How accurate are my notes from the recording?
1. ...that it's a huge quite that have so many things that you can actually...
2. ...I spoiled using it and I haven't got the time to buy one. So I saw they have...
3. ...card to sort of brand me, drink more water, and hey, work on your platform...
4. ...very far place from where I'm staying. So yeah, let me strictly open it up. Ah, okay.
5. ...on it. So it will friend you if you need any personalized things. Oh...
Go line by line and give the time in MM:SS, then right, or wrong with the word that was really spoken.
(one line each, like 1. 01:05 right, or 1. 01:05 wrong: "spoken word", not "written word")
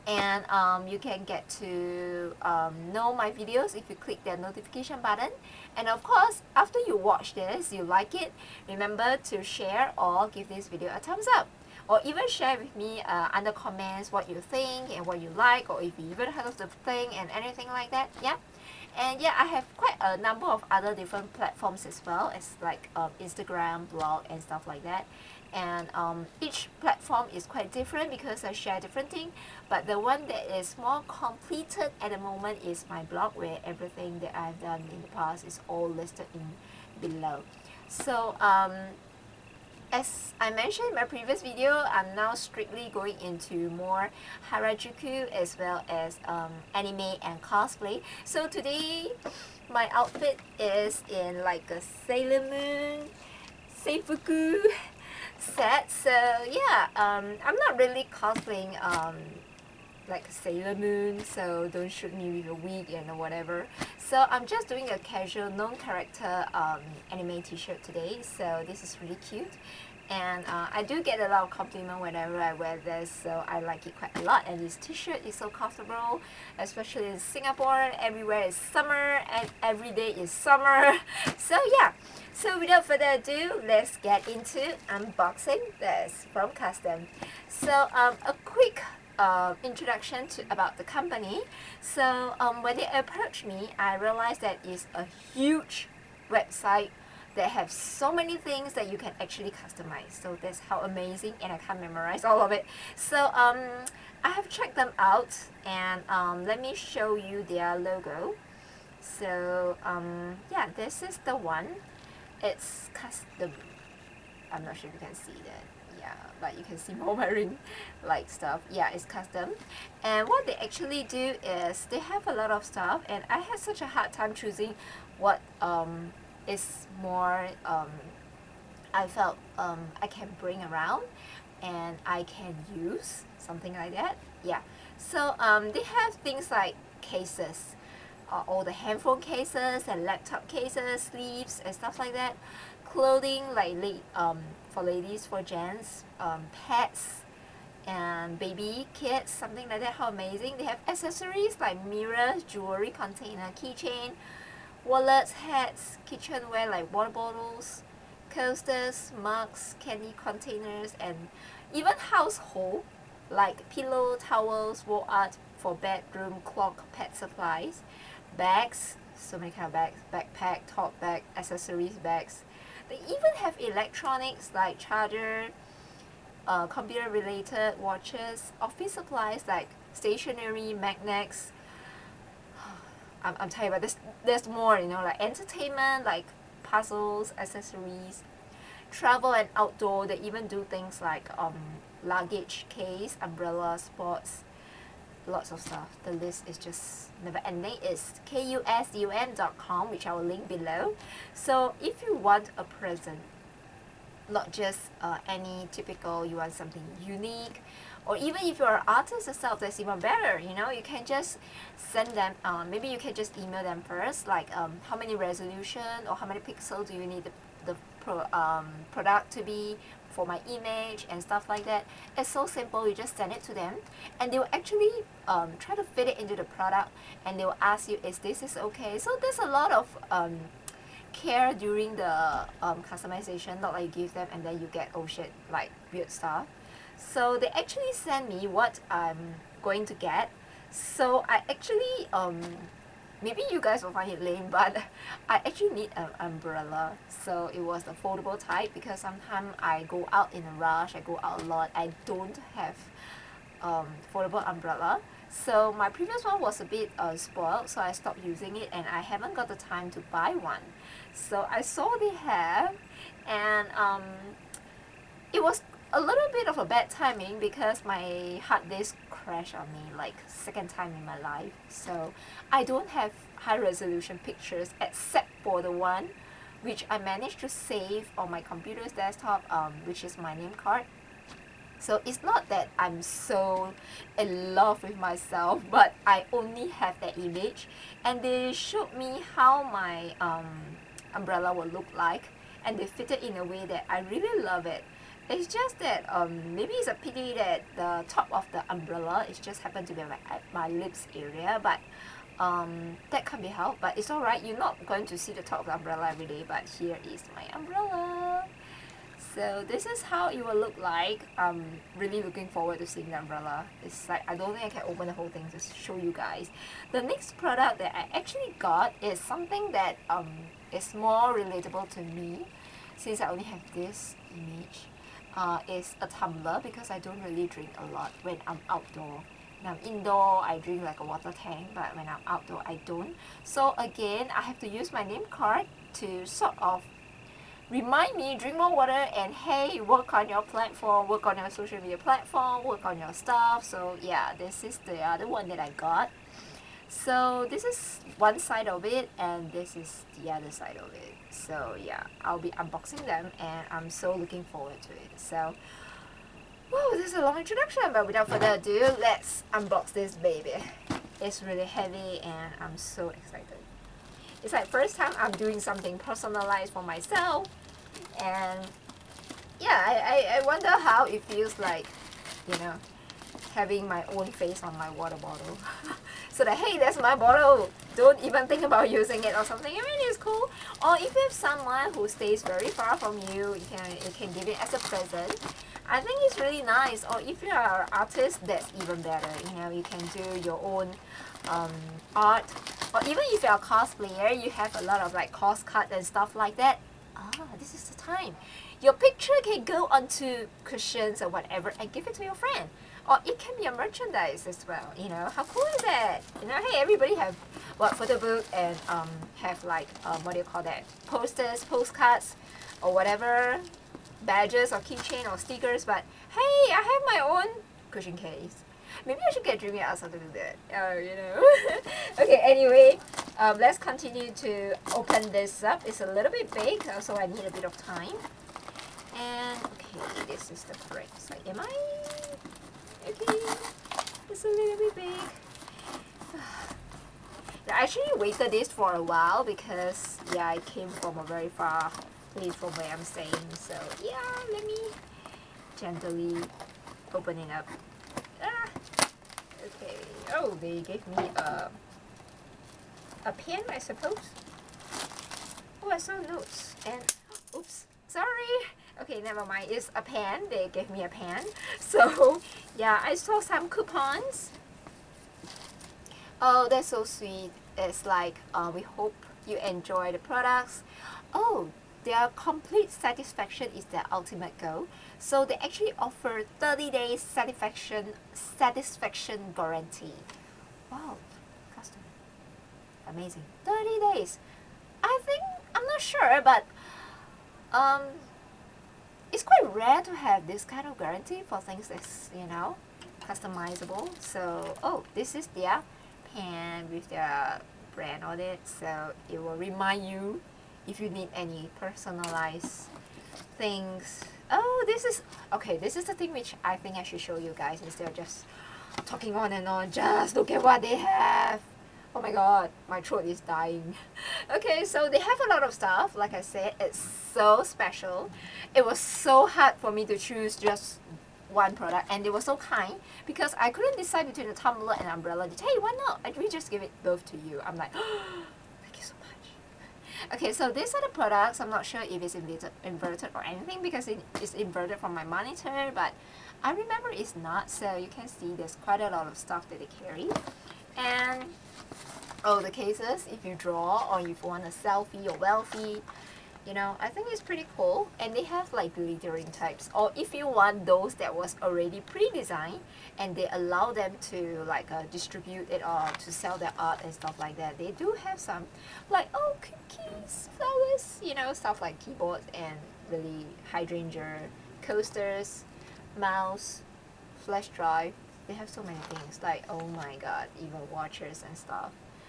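1. 01:34 wrong: "website", not "quite"
2. 04:17 wrong: "stopped", not "spoiled"
3. 05:35 wrong: "remind", not "brand"
4. 07:21 wrong: "gently", not "strictly"
5. 08:18 wrong: "remind", not "friend".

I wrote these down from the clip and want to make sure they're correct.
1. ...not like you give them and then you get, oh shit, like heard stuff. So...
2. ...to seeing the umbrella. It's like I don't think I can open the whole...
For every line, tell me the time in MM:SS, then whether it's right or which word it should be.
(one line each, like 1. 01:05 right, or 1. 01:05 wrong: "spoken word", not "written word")
1. 03:53 wrong: "weird", not "heard"
2. 05:12 right.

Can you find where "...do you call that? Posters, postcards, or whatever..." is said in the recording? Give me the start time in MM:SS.
06:50.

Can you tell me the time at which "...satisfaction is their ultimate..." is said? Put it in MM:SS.
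07:52.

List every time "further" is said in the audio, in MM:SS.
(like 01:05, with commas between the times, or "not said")
01:22, 05:58.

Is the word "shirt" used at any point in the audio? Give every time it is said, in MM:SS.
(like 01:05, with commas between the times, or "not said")
01:07, 01:14.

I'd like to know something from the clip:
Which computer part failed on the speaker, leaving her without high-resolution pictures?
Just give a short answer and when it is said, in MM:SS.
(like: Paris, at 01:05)
Hard disk, at 04:28.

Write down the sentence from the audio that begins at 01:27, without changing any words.
So um, a quick uh, introduction to, about the company.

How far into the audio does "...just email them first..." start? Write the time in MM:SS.
03:33.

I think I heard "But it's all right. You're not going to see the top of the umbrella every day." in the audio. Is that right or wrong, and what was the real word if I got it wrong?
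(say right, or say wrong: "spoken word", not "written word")
right.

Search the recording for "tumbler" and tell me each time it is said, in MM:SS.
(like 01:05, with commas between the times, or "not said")
05:26, 08:44.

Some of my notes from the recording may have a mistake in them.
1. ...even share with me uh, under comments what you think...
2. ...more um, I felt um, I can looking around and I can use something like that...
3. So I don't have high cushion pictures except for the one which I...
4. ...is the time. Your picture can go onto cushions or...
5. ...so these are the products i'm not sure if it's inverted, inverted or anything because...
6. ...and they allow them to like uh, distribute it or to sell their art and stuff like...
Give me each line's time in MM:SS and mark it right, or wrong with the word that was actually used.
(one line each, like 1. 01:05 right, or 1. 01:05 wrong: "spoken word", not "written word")
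1. 00:12 right
2. 02:07 wrong: "bring", not "looking"
3. 04:31 wrong: "resolution", not "cushion"
4. 06:37 right
5. 08:50 right
6. 09:13 right.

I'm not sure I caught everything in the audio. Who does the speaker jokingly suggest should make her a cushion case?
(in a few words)
Dreamy Asa.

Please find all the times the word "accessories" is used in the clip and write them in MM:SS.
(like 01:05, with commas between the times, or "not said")
02:30, 02:51, 03:07.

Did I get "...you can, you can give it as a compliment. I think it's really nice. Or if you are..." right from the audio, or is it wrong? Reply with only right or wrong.
wrong.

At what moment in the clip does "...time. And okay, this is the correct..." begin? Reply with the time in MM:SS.
07:07.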